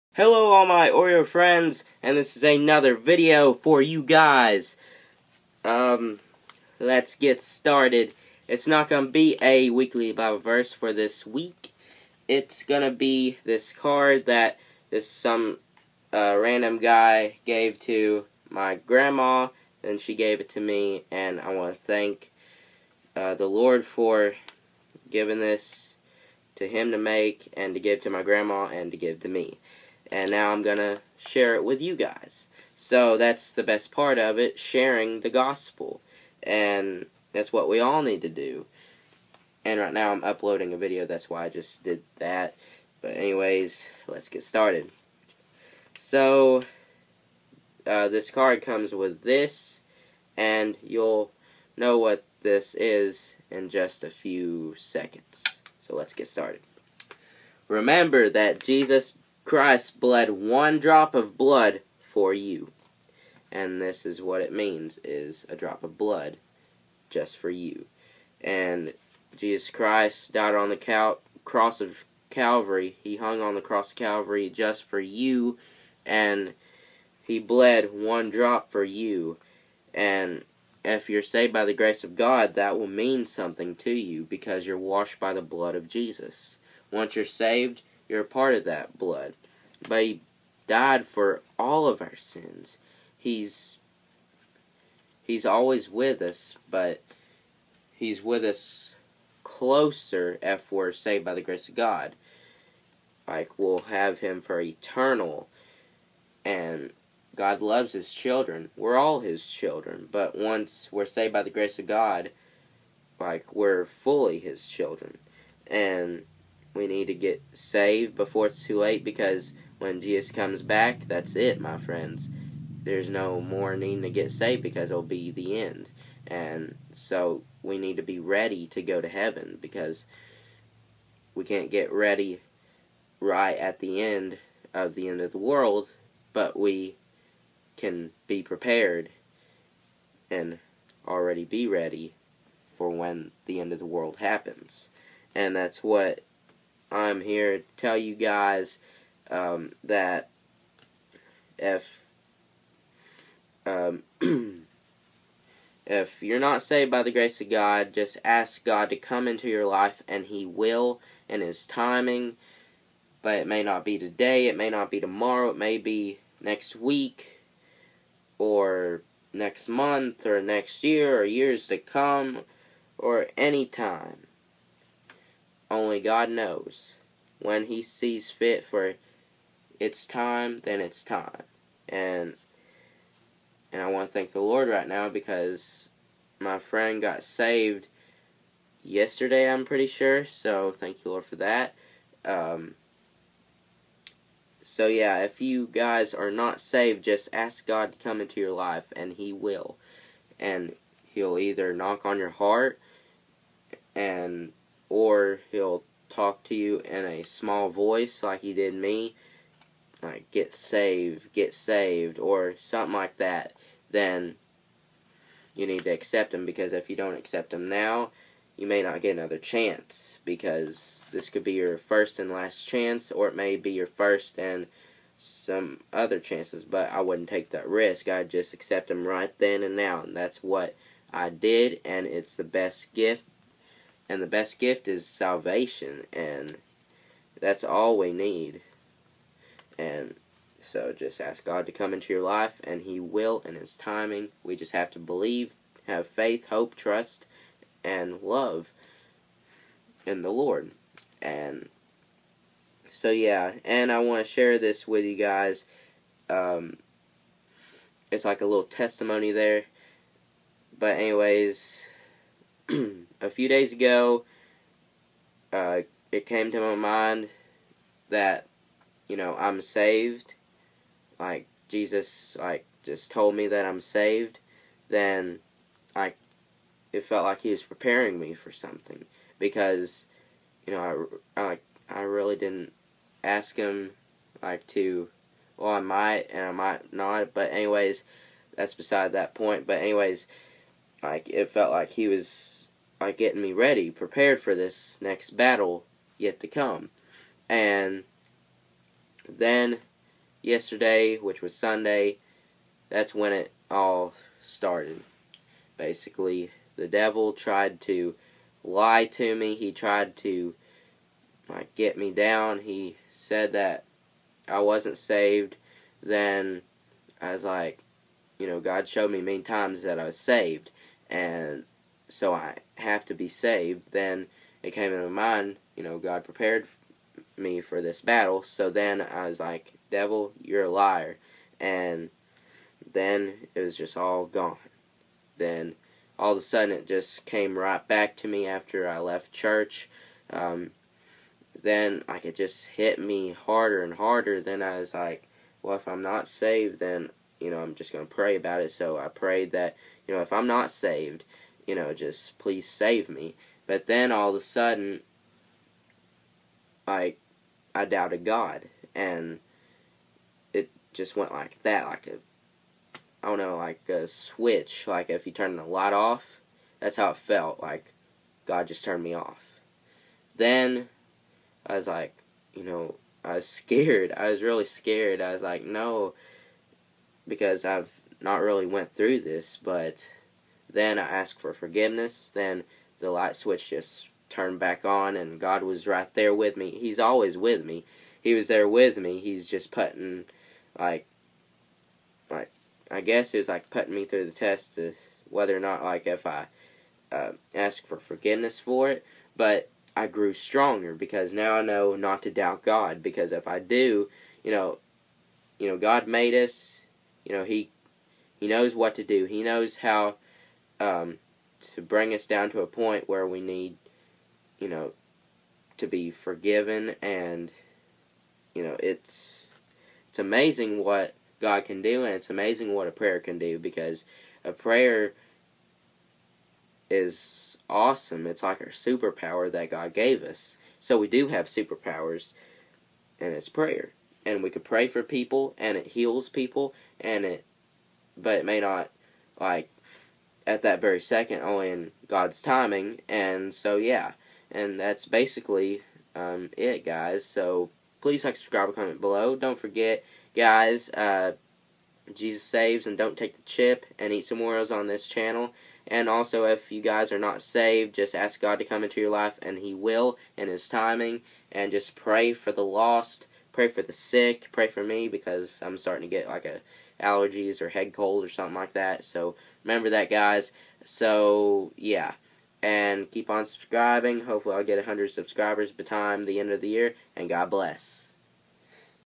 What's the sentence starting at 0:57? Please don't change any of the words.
Remember that Jesus Christ bled one drop of blood for you.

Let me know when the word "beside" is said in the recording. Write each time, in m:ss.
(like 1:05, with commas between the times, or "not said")
4:48.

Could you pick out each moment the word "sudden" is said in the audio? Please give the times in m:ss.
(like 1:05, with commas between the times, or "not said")
5:36, 5:54.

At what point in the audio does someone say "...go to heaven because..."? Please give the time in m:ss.
2:08.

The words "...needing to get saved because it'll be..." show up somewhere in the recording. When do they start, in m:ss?
2:03.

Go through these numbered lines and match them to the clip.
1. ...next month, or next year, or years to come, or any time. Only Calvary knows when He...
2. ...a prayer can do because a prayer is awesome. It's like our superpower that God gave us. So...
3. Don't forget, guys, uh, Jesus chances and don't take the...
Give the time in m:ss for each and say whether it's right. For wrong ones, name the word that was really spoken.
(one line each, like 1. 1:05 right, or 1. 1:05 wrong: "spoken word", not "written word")
1. 2:49 wrong: "God", not "Calvary"
2. 7:02 right
3. 7:29 wrong: "saves", not "chances".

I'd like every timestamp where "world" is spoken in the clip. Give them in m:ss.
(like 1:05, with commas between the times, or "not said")
2:15, 2:23.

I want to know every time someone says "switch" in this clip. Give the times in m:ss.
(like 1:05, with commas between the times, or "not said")
6:04, 6:23.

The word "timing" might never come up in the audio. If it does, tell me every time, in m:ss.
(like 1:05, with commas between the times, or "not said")
2:41, 4:03, 7:22, 7:40.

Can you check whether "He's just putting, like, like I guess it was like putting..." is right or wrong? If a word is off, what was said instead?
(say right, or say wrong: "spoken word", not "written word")
right.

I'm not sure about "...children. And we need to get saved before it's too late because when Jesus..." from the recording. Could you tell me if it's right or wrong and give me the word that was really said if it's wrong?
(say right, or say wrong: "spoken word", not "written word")
right.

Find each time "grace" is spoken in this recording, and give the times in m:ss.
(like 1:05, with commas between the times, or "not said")
1:21, 1:41, 1:51, 2:37.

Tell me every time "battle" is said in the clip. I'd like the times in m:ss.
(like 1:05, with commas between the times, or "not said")
4:55, 5:28.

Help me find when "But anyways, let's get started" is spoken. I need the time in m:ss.
0:43.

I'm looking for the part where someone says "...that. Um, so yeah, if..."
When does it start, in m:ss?
3:11.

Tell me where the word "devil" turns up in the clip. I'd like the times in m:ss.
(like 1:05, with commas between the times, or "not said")
5:06, 5:29.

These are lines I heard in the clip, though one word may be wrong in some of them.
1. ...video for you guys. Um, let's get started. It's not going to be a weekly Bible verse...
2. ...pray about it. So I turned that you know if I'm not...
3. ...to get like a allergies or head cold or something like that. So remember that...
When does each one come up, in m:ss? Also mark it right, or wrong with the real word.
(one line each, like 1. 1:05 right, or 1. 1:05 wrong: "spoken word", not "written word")
1. 0:02 right
2. 5:48 wrong: "prayed", not "turned"
3. 7:46 right.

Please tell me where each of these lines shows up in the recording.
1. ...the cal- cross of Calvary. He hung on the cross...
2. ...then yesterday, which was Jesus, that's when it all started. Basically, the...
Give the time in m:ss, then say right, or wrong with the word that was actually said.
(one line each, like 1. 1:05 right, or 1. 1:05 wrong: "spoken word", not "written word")
1. 1:10 right
2. 4:59 wrong: "Sunday", not "Jesus".